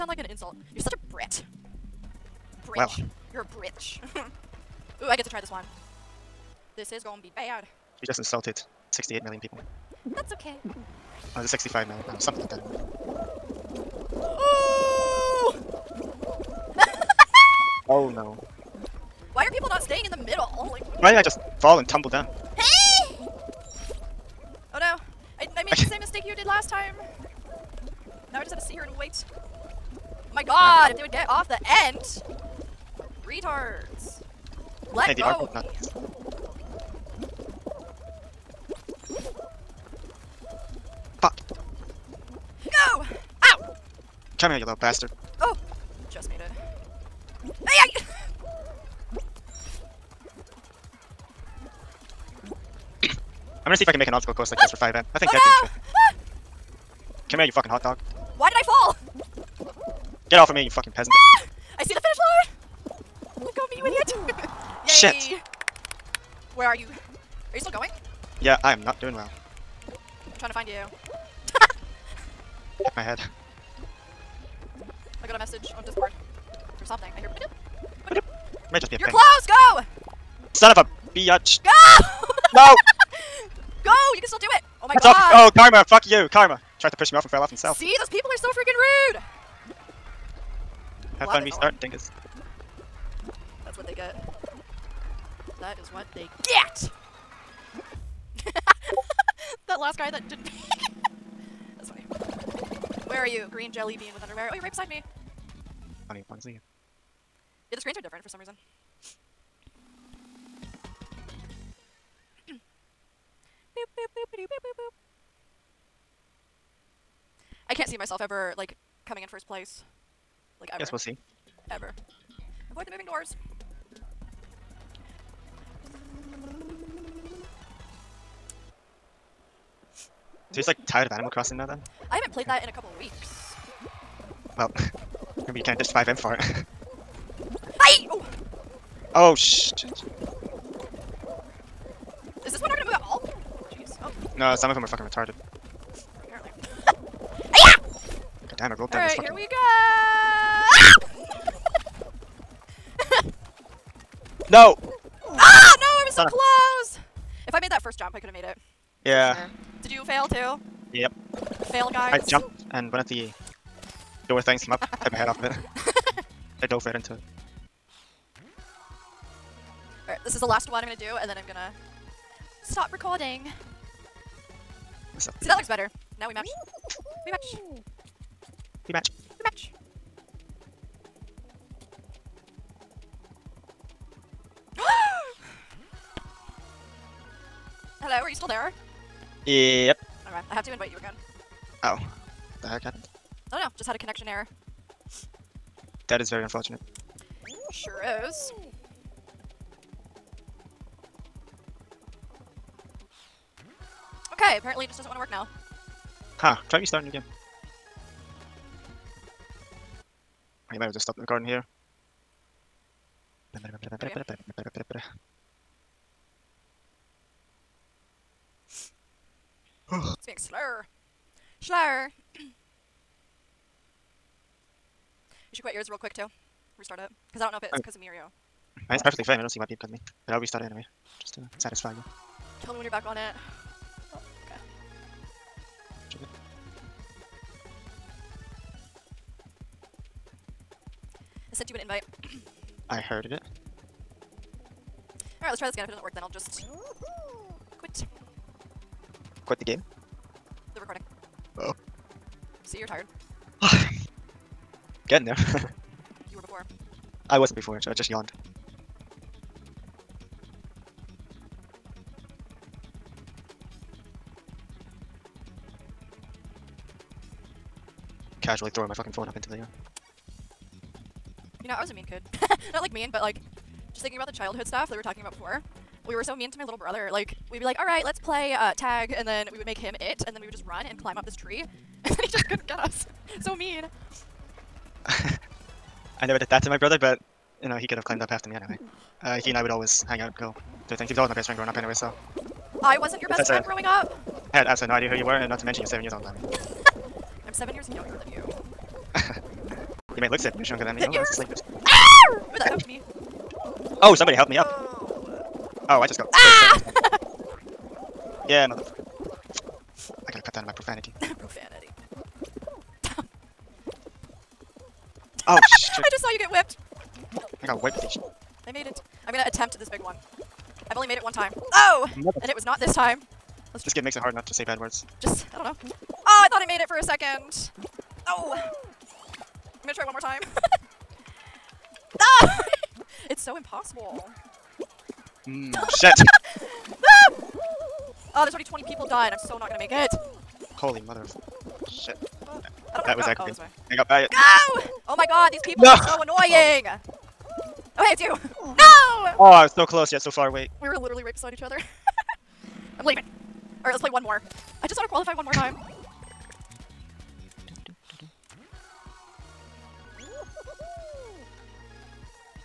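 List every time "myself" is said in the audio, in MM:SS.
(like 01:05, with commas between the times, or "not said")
01:57.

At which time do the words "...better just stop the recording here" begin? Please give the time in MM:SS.
03:30.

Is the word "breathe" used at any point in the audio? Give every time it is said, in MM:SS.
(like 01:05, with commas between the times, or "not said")
not said.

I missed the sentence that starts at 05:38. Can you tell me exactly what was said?
Oh, there's already 20 people done.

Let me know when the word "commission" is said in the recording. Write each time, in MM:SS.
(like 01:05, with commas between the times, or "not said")
not said.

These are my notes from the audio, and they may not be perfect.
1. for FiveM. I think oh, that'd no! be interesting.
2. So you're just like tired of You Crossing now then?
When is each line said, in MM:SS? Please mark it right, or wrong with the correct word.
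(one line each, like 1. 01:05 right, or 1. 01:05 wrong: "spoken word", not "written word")
1. 00:54 right
2. 02:10 wrong: "Animal", not "You".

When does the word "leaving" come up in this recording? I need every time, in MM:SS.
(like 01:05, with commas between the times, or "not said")
05:53.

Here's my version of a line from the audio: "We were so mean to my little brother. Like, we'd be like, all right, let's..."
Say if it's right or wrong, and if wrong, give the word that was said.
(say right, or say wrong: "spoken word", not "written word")
right.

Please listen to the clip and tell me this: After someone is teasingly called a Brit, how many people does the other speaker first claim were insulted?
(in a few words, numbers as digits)
68 million.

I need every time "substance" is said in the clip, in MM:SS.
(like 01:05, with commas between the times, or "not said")
not said.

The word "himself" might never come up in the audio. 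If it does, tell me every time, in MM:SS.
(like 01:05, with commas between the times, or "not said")
01:27.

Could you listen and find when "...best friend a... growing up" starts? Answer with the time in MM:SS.
04:53.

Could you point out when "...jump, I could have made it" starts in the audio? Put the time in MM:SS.
02:37.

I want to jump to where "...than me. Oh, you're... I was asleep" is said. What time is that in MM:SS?
05:00.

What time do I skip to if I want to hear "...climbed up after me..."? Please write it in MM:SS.
04:48.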